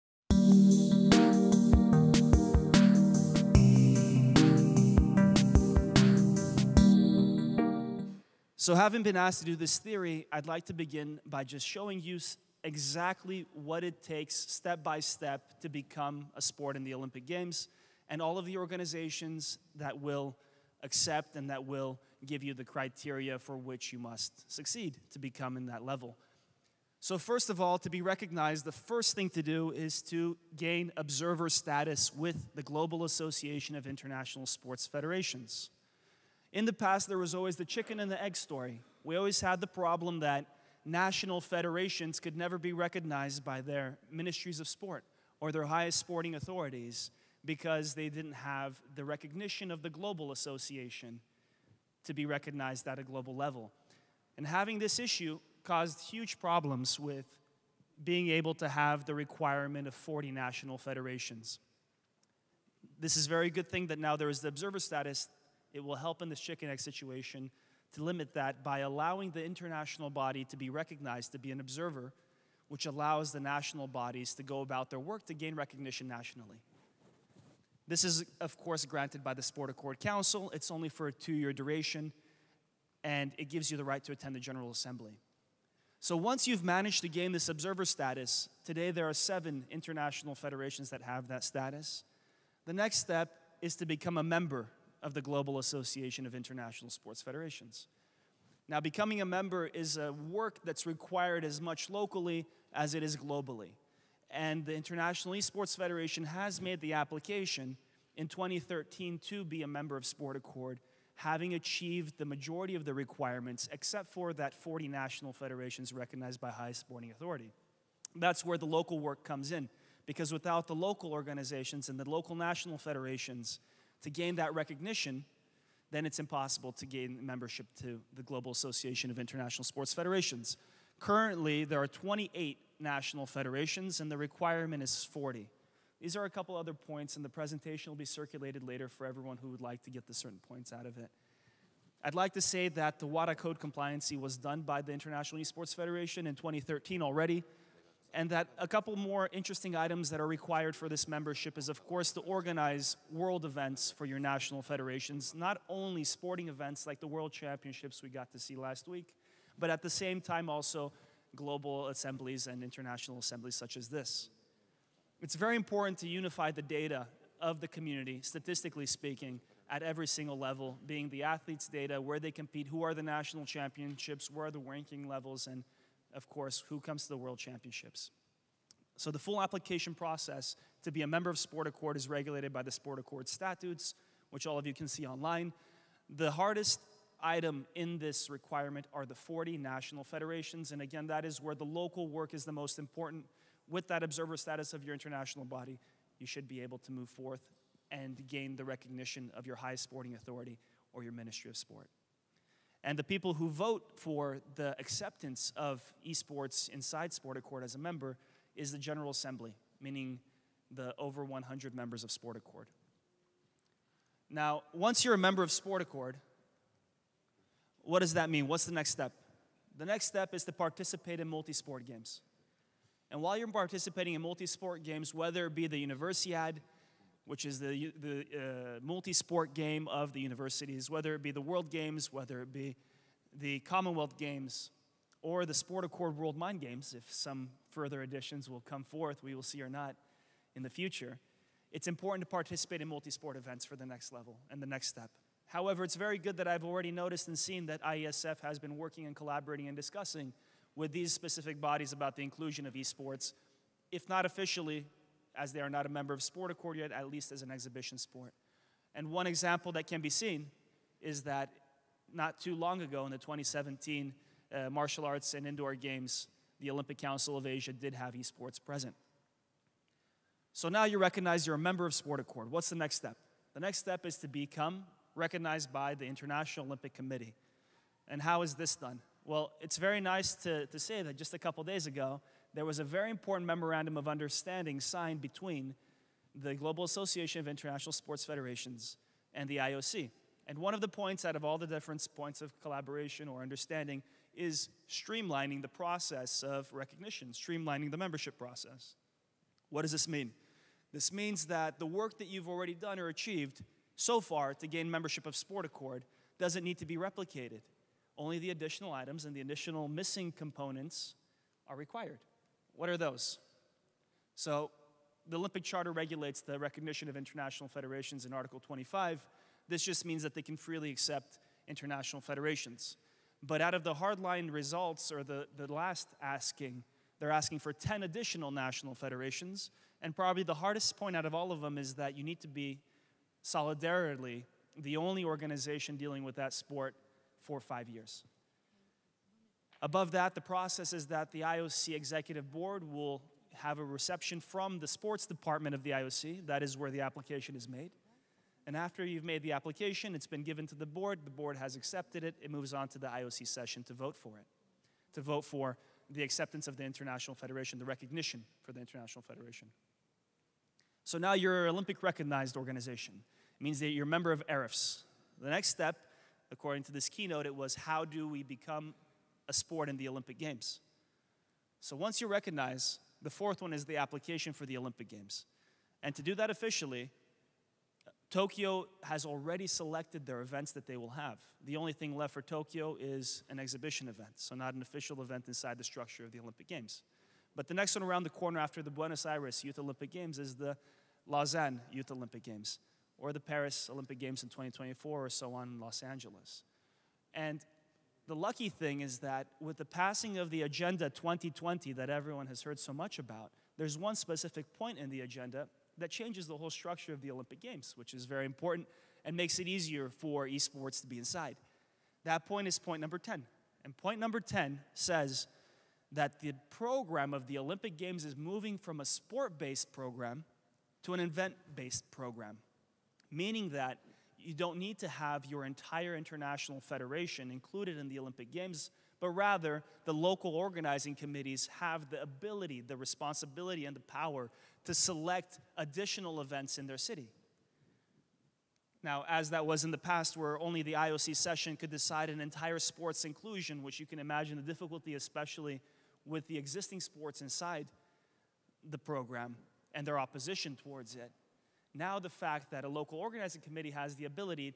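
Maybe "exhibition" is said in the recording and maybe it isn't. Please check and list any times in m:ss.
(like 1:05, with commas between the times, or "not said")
4:17, 6:23.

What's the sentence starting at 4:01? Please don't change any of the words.
It's important to participate in multi sport events for the next level and the next step.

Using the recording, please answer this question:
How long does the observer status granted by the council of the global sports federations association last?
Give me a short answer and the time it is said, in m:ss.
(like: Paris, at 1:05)
2 years, at 1:21.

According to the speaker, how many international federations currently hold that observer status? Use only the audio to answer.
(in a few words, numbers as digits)
7.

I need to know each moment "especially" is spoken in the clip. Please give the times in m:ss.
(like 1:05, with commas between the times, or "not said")
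7:25.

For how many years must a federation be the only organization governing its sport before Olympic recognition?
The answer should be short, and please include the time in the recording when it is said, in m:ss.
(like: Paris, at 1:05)
5, at 5:37.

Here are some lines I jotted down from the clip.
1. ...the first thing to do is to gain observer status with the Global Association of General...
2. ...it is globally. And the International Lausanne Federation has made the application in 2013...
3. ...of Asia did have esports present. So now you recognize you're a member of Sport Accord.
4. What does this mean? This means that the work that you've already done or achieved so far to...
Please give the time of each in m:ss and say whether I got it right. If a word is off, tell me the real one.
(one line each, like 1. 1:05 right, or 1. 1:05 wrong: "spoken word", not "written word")
1. 0:28 wrong: "International", not "General"
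2. 1:42 wrong: "Esports", not "Lausanne"
3. 4:27 right
4. 4:59 right.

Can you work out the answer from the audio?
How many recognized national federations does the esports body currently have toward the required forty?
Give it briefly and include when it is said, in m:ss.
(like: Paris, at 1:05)
28, at 2:11.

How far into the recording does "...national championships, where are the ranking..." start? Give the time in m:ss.
2:53.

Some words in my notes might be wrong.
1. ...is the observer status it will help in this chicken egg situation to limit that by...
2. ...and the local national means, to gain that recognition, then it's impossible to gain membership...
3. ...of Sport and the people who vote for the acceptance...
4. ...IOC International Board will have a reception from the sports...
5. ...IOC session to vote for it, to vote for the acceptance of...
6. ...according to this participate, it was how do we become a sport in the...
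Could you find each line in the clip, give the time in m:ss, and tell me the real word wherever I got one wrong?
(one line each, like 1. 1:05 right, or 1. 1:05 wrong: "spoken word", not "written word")
1. 1:04 right
2. 2:01 wrong: "federations", not "means"
3. 3:21 right
4. 5:41 wrong: "Executive", not "International"
5. 5:53 right
6. 6:06 wrong: "keynote", not "participate".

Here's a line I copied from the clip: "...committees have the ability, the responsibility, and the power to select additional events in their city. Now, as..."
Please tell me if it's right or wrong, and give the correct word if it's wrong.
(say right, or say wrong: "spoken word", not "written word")
right.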